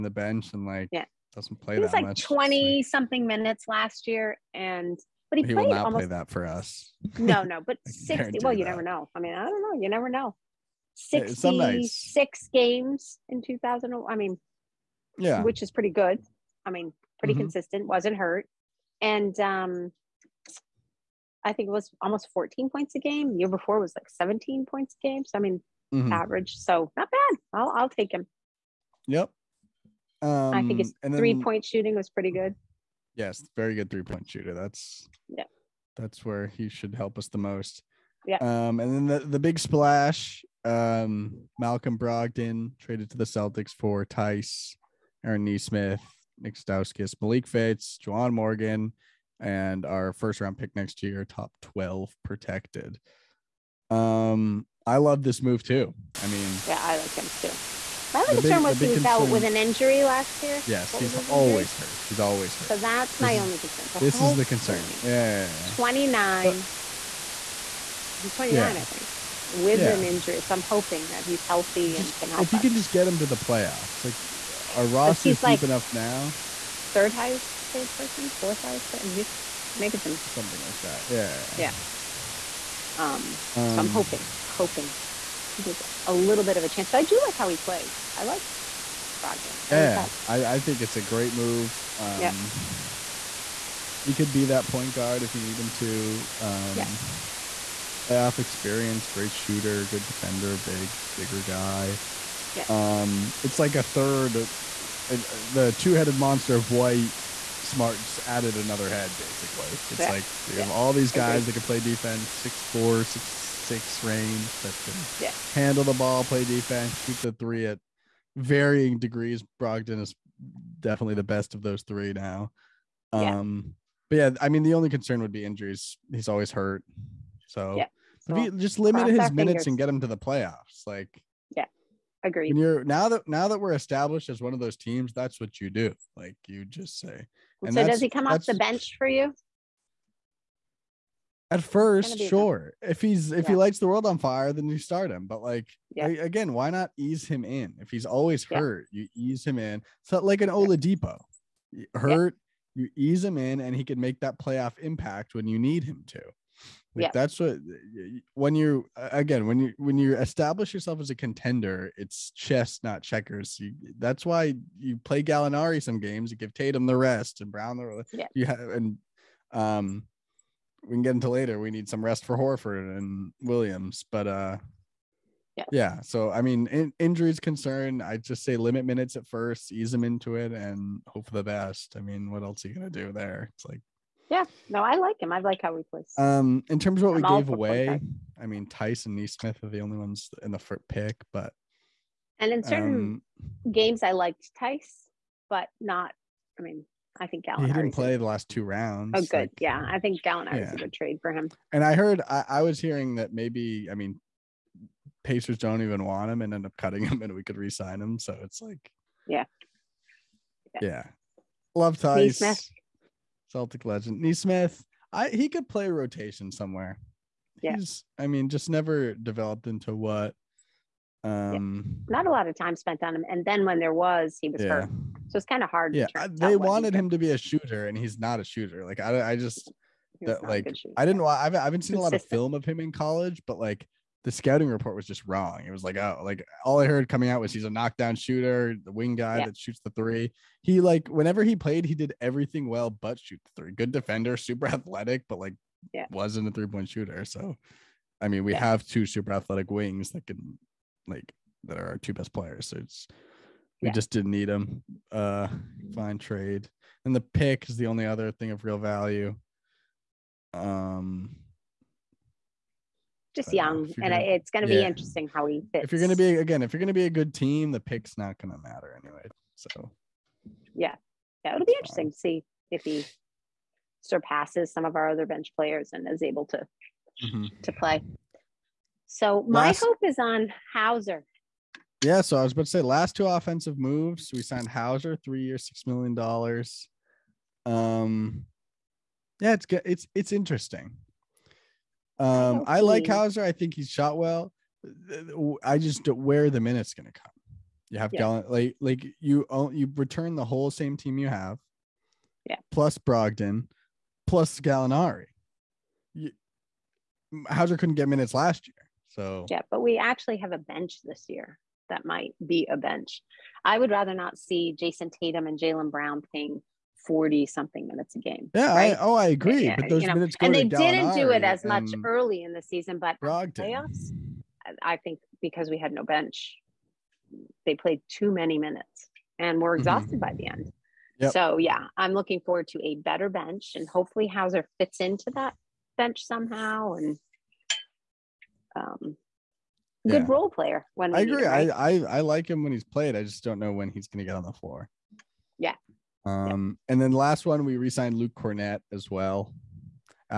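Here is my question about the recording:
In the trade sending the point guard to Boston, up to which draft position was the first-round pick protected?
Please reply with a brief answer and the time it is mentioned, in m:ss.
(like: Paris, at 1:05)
top 12, at 0:51.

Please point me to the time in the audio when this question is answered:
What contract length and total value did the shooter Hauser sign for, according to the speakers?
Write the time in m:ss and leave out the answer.
4:45.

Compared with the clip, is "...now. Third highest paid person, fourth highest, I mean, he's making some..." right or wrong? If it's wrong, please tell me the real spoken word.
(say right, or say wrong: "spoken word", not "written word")
right.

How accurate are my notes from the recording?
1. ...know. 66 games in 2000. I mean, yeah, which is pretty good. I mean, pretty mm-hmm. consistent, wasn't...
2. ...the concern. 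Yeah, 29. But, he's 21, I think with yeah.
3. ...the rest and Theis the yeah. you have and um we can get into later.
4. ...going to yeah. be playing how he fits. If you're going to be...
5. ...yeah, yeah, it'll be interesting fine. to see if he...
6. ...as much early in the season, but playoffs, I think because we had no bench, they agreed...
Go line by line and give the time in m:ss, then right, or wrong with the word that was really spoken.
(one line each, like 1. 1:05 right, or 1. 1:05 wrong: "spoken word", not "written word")
1. 0:10 right
2. 1:04 wrong: "29", not "21"
3. 2:46 wrong: "Brown", not "Theis"
4. 4:24 wrong: "interesting", not "playing"
5. 4:30 right
6. 5:21 wrong: "played", not "agreed".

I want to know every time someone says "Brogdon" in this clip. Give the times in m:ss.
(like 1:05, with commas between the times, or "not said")
0:41, 1:29, 1:59, 5:02.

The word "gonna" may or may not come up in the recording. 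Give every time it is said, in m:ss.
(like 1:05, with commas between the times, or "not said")
3:02, 4:24.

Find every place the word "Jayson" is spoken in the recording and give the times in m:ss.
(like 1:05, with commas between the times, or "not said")
5:14.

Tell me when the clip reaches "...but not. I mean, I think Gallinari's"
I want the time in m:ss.
3:15.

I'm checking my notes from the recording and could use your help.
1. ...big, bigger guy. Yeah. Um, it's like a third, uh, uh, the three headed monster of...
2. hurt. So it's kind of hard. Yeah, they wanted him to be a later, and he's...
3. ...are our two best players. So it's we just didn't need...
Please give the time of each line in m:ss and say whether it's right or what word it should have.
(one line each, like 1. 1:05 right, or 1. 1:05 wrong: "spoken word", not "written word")
1. 1:40 wrong: "two", not "three"
2. 3:44 wrong: "shooter", not "later"
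3. 4:11 right.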